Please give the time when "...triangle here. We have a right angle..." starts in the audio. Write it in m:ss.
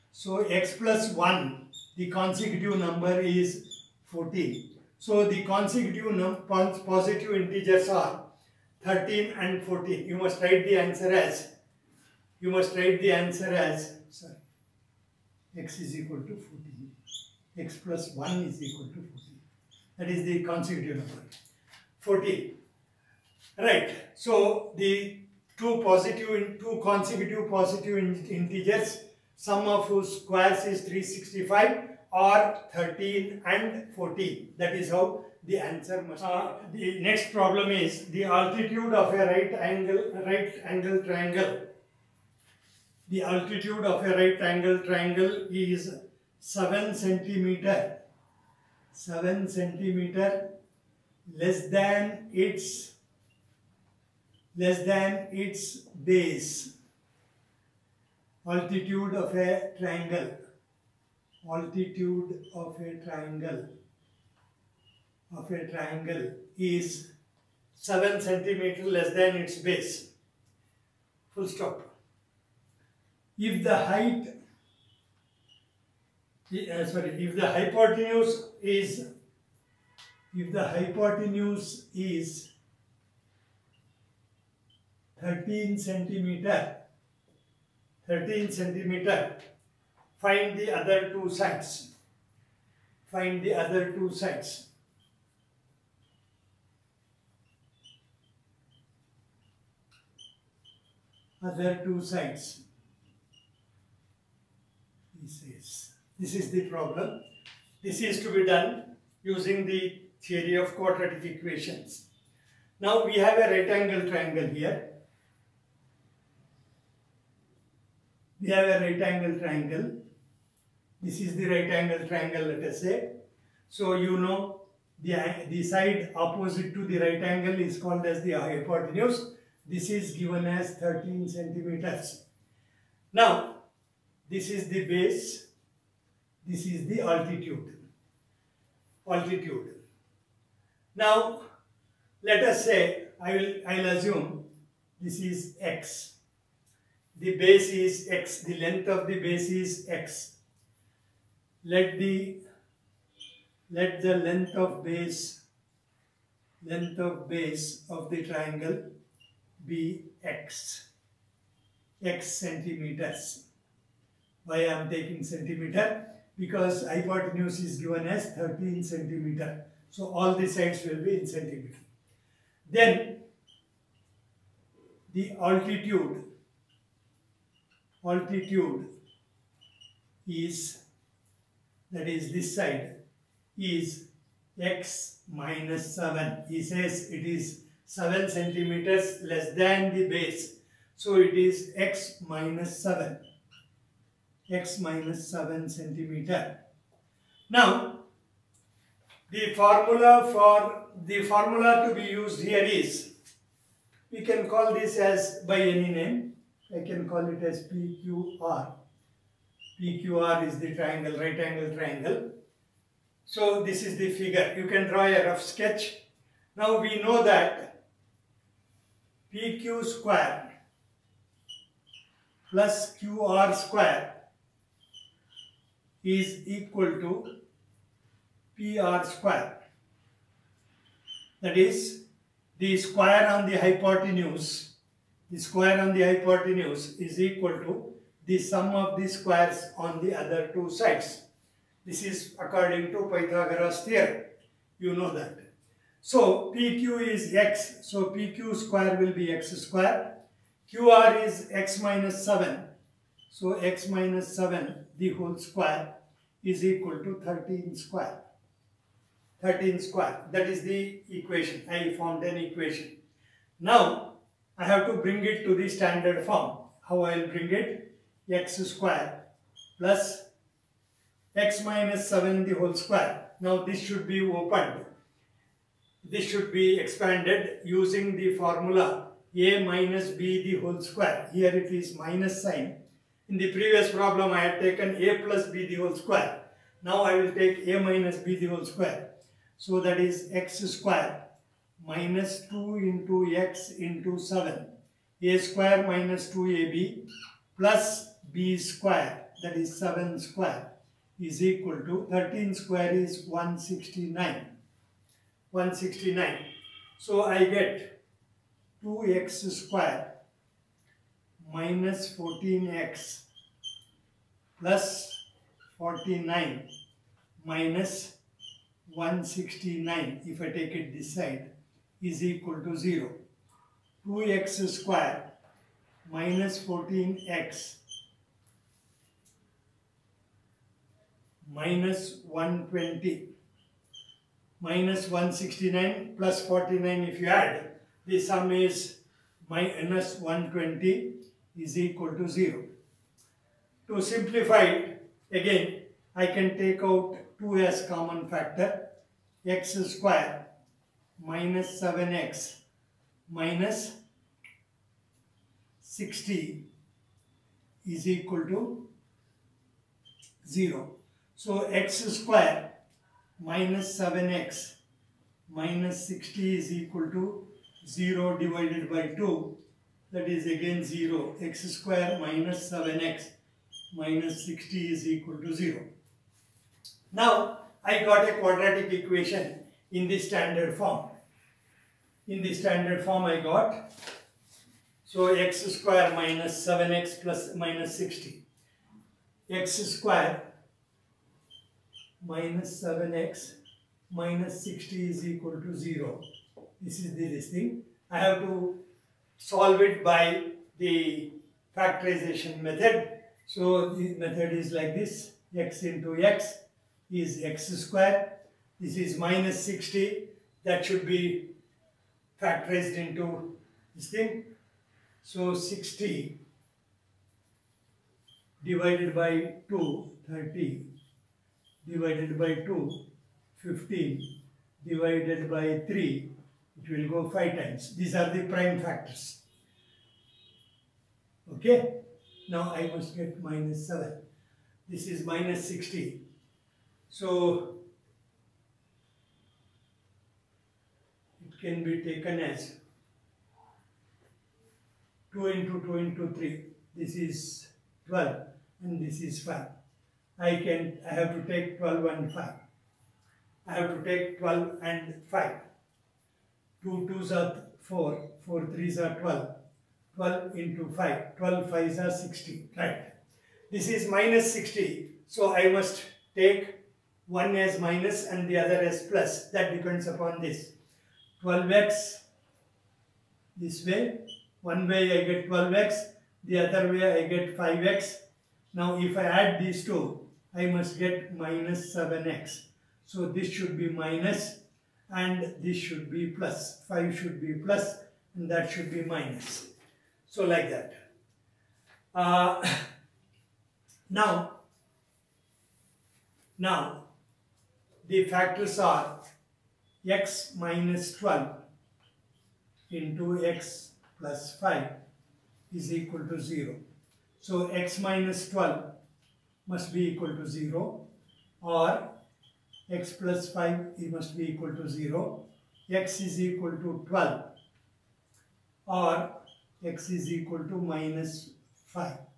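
1:54.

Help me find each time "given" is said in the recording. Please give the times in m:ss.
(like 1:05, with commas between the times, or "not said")
2:10, 2:47.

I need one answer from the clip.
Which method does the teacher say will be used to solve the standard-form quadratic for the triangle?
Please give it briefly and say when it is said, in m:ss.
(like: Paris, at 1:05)
factorization method, at 6:41.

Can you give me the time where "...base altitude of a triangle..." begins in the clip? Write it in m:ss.
0:56.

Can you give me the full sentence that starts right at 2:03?
So you know the, the side opposite to the right angle is called as the hypotenuse.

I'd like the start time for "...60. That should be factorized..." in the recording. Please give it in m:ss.
6:49.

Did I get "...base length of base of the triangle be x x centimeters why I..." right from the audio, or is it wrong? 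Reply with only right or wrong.
right.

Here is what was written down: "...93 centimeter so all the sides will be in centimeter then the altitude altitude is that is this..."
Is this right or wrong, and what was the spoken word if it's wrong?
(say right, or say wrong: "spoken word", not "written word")
wrong: "13", not "93".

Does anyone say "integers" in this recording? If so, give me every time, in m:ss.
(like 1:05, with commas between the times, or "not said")
0:07, 0:28.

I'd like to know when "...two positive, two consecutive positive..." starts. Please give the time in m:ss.
0:25.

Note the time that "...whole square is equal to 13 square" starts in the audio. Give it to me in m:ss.
4:15.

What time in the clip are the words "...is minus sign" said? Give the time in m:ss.
4:41.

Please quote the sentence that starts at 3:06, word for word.
He says it is 7 centimeters less than the base.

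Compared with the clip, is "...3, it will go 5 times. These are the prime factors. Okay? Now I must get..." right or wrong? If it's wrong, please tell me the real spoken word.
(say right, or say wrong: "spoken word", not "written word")
right.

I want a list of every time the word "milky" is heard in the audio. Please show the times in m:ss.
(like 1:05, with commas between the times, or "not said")
not said.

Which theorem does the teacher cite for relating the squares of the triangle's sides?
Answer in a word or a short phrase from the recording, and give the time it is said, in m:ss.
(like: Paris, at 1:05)
Pythagoras theorem, at 4:03.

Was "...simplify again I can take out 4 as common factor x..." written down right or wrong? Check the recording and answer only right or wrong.
wrong.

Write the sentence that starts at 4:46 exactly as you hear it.
Now I will take a minus b the whole square.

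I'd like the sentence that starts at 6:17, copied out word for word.
Now I got a quadratic equation in the standard form.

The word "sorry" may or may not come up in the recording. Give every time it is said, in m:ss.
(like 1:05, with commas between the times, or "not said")
0:14, 1:16.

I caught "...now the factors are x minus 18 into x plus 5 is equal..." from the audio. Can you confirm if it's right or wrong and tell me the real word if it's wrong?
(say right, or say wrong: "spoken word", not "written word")
wrong: "12", not "18".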